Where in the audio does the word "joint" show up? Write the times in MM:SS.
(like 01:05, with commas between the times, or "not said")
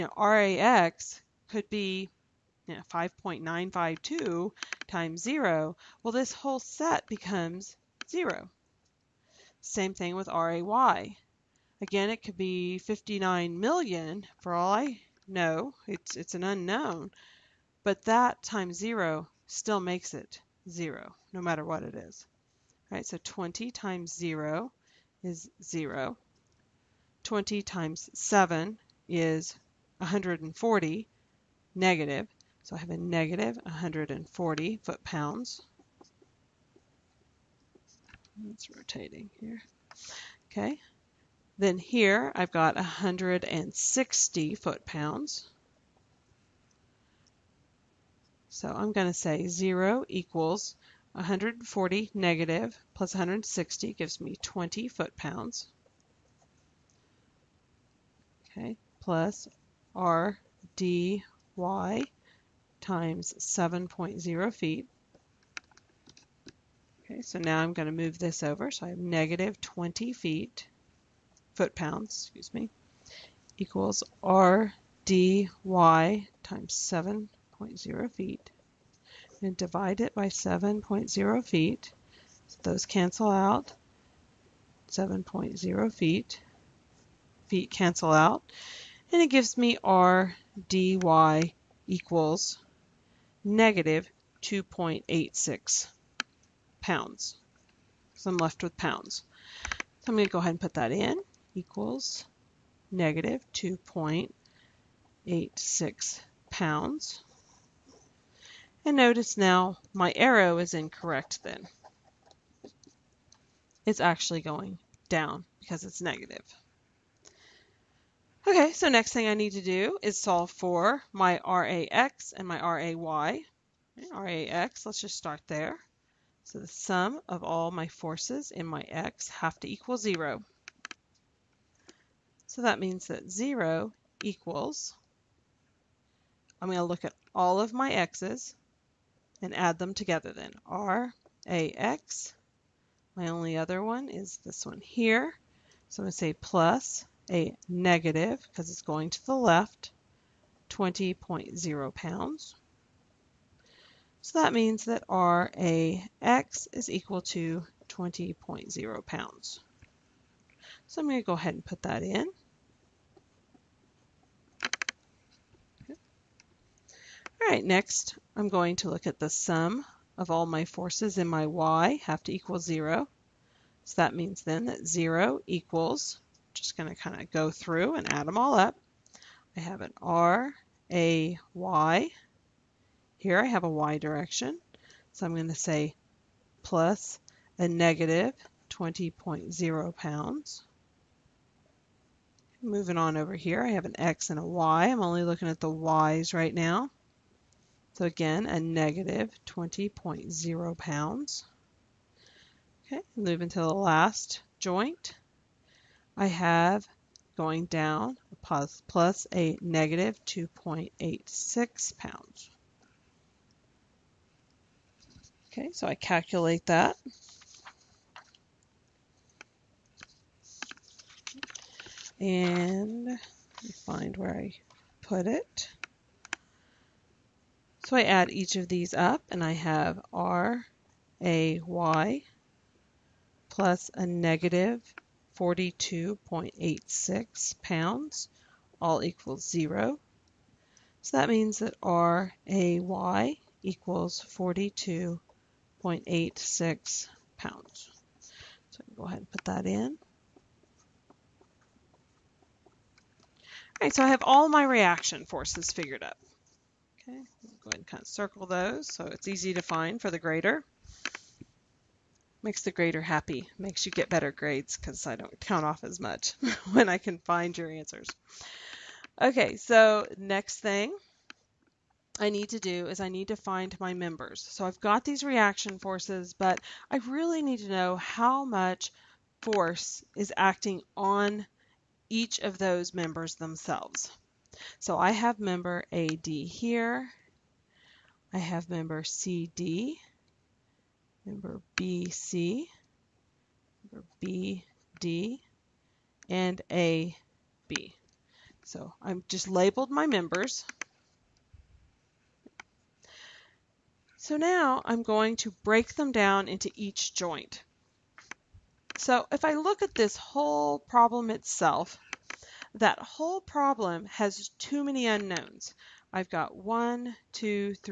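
03:24, 05:07.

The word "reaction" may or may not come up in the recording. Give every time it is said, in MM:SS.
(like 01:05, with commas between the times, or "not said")
04:14, 04:35.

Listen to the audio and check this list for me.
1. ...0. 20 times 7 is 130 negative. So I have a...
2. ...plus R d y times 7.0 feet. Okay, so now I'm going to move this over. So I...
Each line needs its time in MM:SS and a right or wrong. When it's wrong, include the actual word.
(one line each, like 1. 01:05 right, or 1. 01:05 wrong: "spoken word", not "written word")
1. 00:25 wrong: "140", not "130"
2. 00:58 right.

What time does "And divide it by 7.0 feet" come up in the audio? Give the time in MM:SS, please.
01:19.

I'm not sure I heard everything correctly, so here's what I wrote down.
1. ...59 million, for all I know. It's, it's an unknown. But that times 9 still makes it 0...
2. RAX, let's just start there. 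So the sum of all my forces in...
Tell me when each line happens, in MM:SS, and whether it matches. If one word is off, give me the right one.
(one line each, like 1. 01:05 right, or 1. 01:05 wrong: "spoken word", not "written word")
1. 00:12 wrong: "0", not "9"
2. 02:04 right.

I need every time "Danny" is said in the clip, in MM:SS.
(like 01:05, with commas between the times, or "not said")
not said.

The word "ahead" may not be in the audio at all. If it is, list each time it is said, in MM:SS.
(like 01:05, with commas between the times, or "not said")
01:40, 02:41, 04:09, 04:17.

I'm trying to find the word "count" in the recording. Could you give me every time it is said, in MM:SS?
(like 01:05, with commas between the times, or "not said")
04:25.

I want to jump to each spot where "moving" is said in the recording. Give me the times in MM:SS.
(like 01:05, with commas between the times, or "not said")
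03:12, 03:23.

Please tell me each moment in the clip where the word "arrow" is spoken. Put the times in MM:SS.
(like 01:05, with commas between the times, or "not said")
01:50.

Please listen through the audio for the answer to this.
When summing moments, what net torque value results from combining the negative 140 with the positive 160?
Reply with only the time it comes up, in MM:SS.
00:54.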